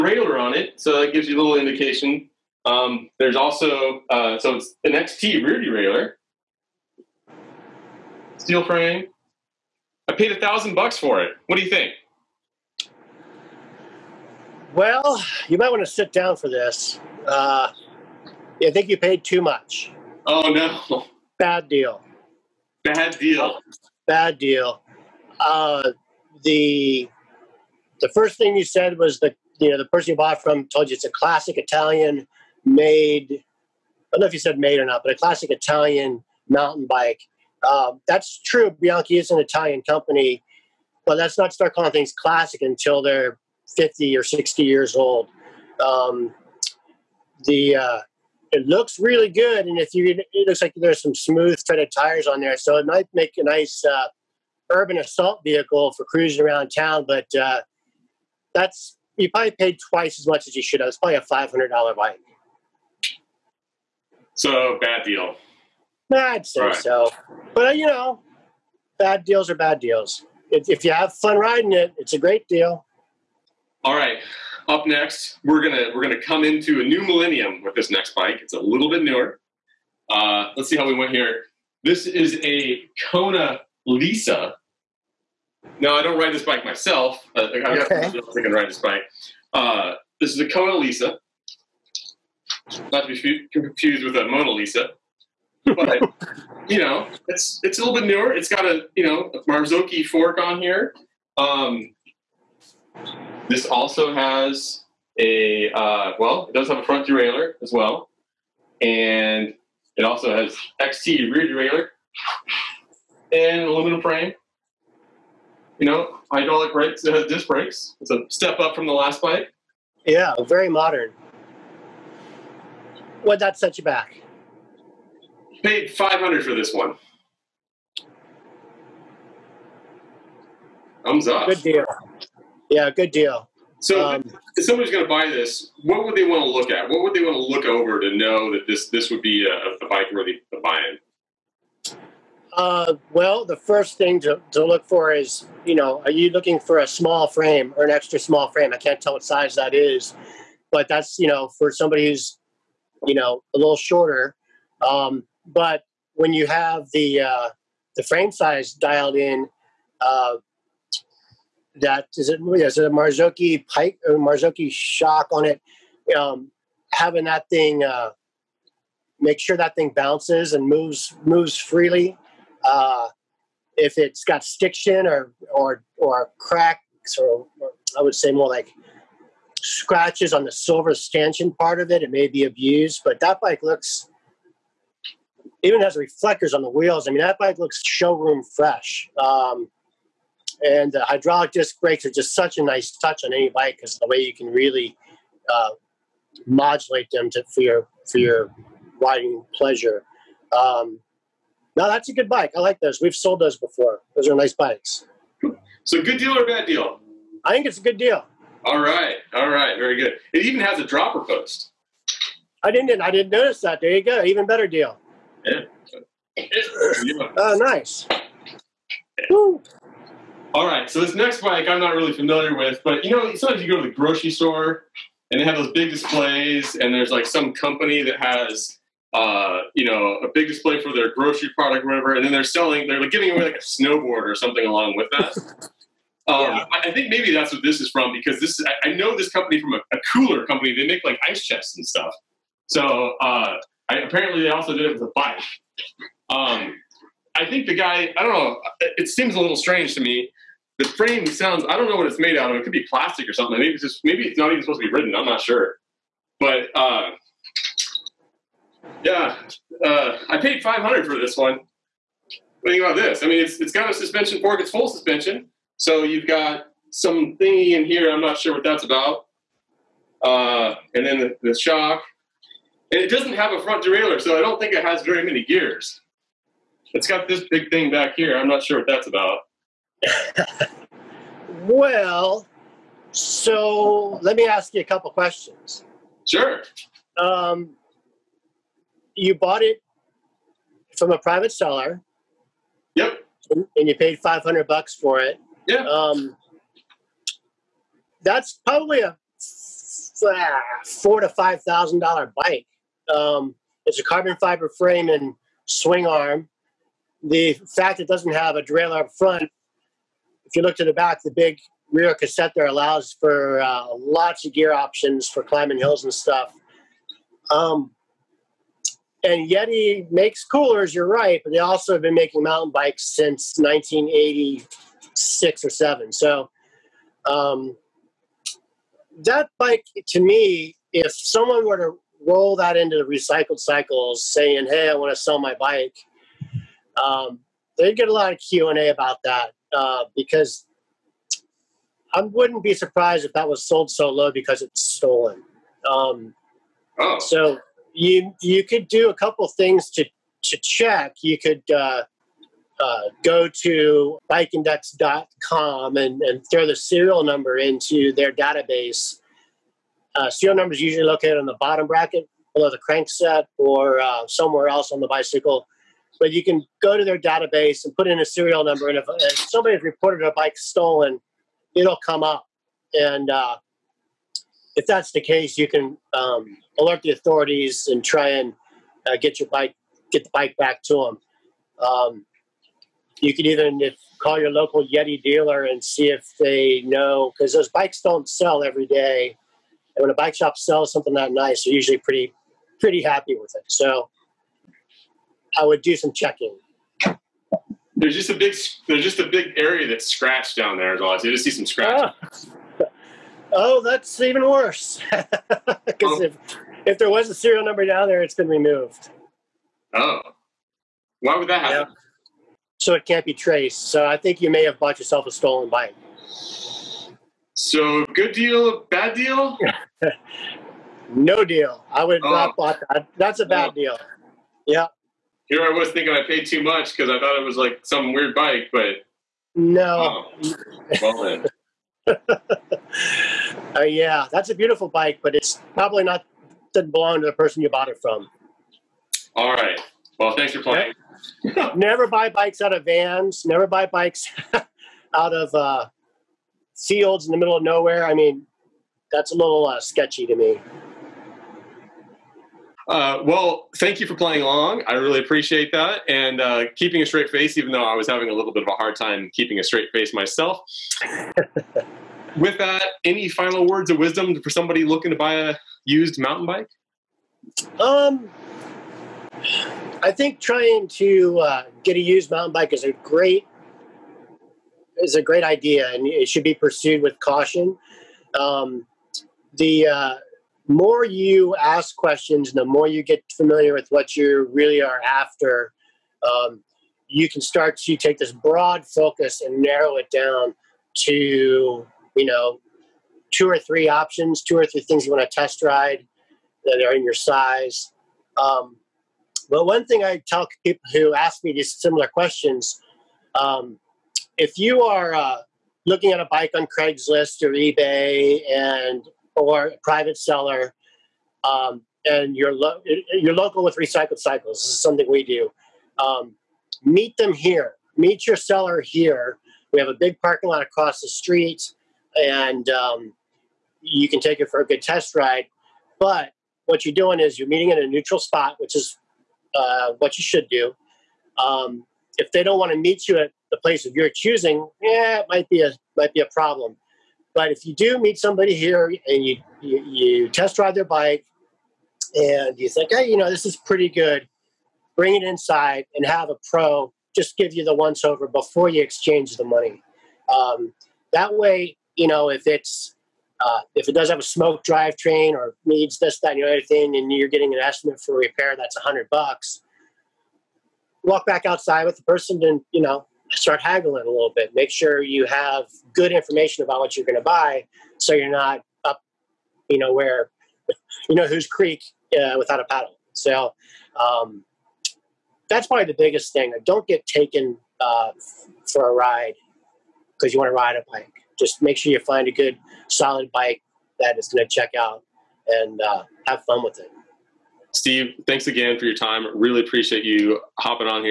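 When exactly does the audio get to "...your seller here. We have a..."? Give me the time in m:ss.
8:38.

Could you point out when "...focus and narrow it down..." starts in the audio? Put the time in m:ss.
8:08.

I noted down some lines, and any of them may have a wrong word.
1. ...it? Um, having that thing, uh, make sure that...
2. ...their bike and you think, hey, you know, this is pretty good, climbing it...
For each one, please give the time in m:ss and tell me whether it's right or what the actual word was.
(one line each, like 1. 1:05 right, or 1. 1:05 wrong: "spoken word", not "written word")
1. 2:45 right
2. 9:00 wrong: "bring", not "climbing".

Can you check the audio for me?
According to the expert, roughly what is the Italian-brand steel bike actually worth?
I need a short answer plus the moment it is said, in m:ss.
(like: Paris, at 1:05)
$500, at 1:01.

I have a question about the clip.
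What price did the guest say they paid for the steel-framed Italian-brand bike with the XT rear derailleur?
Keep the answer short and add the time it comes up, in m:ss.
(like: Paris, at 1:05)
$1,000, at 0:10.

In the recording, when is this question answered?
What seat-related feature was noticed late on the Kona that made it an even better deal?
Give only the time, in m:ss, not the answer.
3:30.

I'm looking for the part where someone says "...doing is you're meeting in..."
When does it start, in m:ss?
8:46.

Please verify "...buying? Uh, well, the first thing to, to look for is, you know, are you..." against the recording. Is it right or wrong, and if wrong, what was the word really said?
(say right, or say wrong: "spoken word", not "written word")
right.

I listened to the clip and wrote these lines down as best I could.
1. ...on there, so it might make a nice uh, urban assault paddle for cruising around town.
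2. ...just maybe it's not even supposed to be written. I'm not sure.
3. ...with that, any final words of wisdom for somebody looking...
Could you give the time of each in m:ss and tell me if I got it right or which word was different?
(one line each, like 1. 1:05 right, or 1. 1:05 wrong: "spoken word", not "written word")
1. 0:52 wrong: "vehicle", not "paddle"
2. 4:13 right
3. 7:42 right.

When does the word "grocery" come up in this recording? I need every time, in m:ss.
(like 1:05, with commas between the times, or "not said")
3:43, 3:51.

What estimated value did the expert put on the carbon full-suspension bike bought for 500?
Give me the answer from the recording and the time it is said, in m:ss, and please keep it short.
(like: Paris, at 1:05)
$4,000 to $5,000, at 5:00.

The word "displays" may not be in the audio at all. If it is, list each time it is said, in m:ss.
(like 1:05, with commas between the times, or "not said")
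3:45, 3:50.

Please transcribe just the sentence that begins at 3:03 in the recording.
But that bike looks even has reflectors on the wheels.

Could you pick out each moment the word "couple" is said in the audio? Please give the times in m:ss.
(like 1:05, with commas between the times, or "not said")
4:44, 5:49.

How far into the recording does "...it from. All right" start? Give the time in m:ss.
7:17.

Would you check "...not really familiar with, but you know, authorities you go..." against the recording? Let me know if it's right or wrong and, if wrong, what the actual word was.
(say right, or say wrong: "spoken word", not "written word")
wrong: "sometimes", not "authorities".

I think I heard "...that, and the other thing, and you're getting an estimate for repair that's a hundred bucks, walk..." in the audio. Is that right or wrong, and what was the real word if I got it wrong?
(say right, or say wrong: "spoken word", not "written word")
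right.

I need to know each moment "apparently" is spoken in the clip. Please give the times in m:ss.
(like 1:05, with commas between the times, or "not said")
4:04.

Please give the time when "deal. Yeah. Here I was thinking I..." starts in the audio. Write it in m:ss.
7:03.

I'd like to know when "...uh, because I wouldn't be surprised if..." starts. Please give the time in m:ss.
5:39.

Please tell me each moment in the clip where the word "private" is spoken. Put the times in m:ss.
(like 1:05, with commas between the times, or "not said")
4:51, 8:29.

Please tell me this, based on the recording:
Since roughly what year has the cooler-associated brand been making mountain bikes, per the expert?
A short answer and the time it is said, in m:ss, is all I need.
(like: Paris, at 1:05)
1986, at 5:23.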